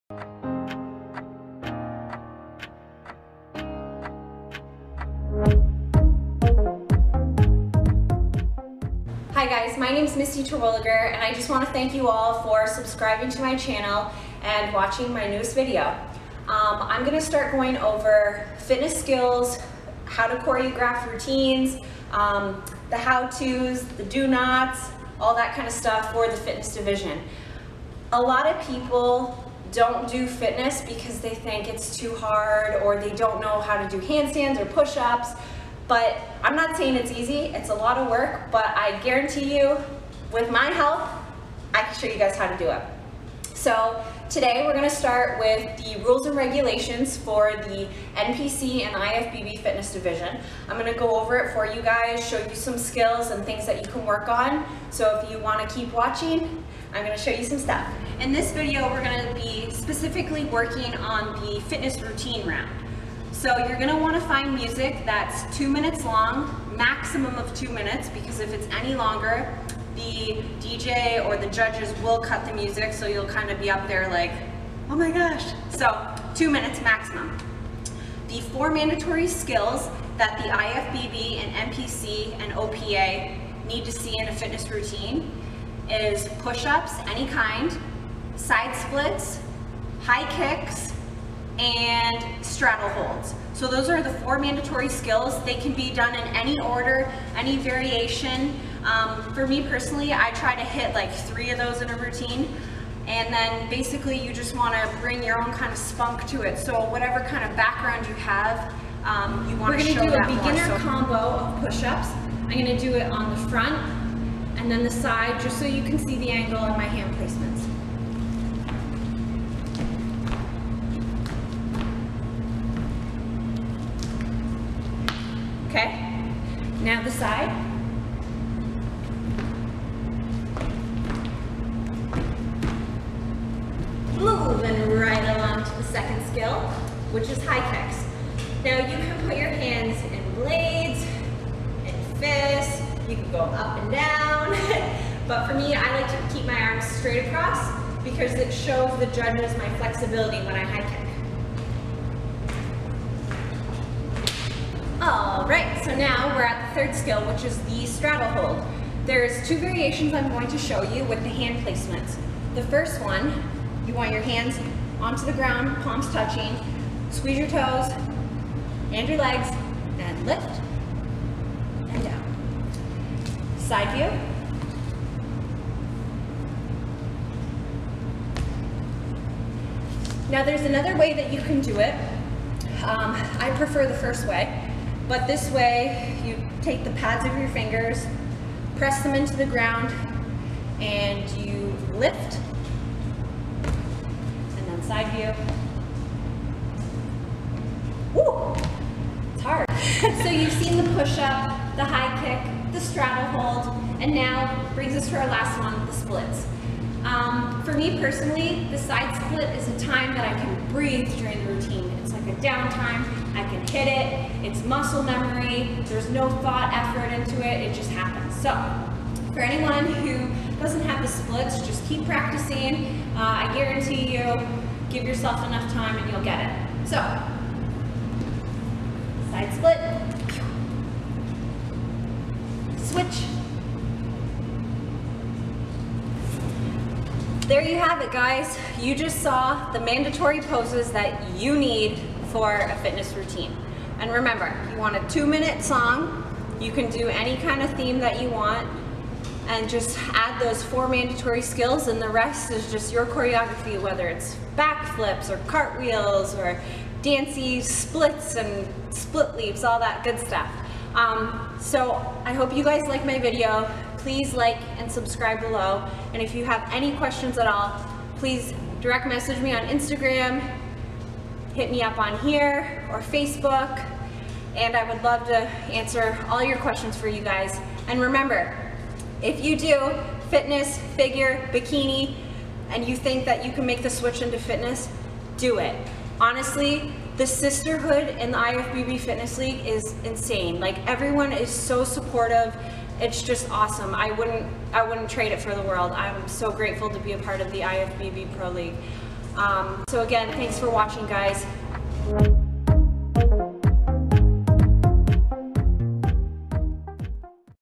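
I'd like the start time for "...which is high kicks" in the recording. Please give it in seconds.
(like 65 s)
137 s.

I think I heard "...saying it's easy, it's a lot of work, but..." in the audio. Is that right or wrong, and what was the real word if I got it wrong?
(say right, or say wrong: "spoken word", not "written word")
right.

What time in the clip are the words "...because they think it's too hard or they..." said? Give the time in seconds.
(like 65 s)
30 s.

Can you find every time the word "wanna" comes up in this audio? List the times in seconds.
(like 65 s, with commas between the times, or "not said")
55 s, 63 s.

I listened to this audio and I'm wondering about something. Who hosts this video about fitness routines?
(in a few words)
Missy Terwilliger.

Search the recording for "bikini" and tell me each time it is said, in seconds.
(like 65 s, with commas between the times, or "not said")
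281 s.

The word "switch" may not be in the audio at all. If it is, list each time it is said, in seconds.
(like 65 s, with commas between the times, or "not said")
232 s, 283 s.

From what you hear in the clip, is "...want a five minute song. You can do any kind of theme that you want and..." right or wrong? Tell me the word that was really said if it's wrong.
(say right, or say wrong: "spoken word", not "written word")
wrong: "two", not "five".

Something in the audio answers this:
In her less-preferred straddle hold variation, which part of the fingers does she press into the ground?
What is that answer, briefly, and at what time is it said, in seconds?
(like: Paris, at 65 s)
the pads, at 186 s.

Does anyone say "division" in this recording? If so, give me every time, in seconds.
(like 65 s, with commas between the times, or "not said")
26 s, 49 s.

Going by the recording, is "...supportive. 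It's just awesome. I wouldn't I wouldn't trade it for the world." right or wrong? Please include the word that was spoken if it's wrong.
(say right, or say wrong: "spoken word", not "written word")
right.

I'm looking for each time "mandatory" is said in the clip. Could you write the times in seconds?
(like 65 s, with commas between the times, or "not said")
78 s, 94 s, 239 s, 250 s.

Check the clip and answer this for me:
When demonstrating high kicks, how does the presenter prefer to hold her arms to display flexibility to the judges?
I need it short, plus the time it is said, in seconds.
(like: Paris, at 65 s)
straight across, at 146 s.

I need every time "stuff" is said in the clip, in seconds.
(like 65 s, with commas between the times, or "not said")
25 s, 57 s, 260 s.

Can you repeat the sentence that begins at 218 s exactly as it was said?
So, for anyone who doesn't have the splits, just keep practicing.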